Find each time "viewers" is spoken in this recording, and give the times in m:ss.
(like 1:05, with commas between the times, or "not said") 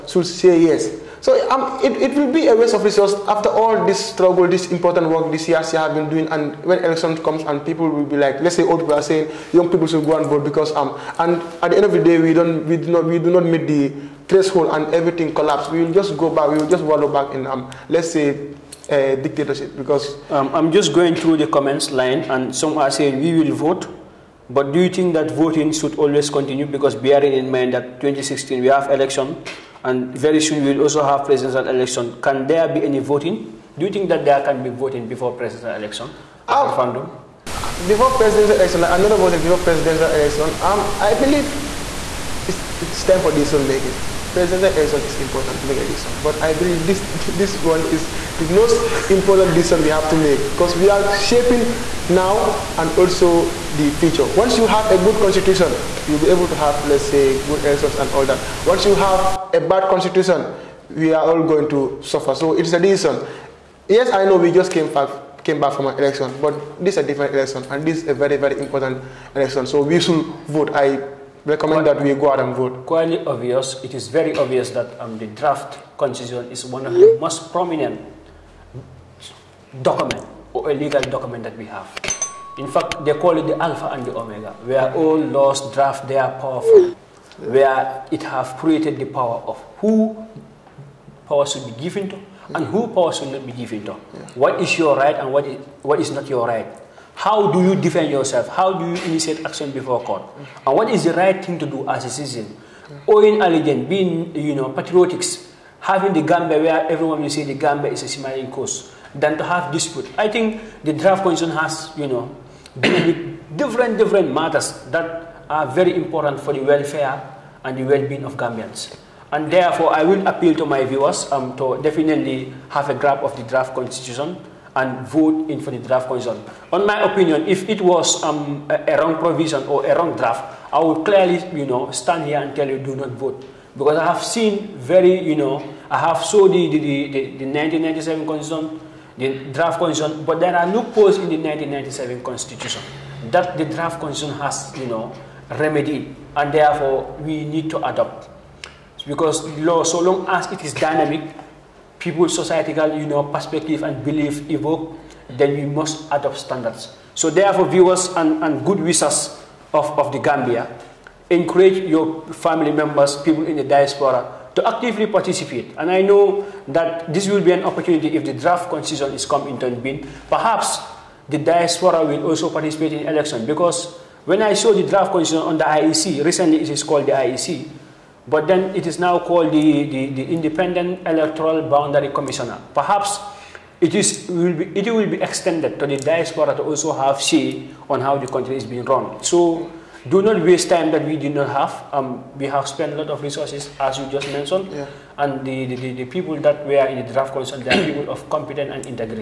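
2:00, 2:37.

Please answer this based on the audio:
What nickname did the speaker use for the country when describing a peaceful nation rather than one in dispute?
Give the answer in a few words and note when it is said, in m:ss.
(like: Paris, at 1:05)
smiling coast, at 1:48.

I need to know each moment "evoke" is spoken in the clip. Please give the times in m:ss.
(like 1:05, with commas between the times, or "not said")
2:34.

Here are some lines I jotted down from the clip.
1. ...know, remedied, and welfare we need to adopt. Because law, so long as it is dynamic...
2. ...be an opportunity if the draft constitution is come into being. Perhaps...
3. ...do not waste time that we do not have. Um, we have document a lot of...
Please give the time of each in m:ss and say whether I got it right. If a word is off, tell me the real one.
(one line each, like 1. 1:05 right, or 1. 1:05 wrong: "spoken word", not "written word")
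1. 2:24 wrong: "therefore", not "welfare"
2. 2:47 right
3. 3:10 wrong: "spent", not "document".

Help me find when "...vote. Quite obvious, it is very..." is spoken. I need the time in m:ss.
1:12.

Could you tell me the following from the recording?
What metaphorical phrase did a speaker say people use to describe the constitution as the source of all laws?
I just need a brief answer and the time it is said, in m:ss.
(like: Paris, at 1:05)
the alpha and the omega, at 1:23.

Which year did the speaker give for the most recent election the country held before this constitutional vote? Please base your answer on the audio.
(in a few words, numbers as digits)
2016.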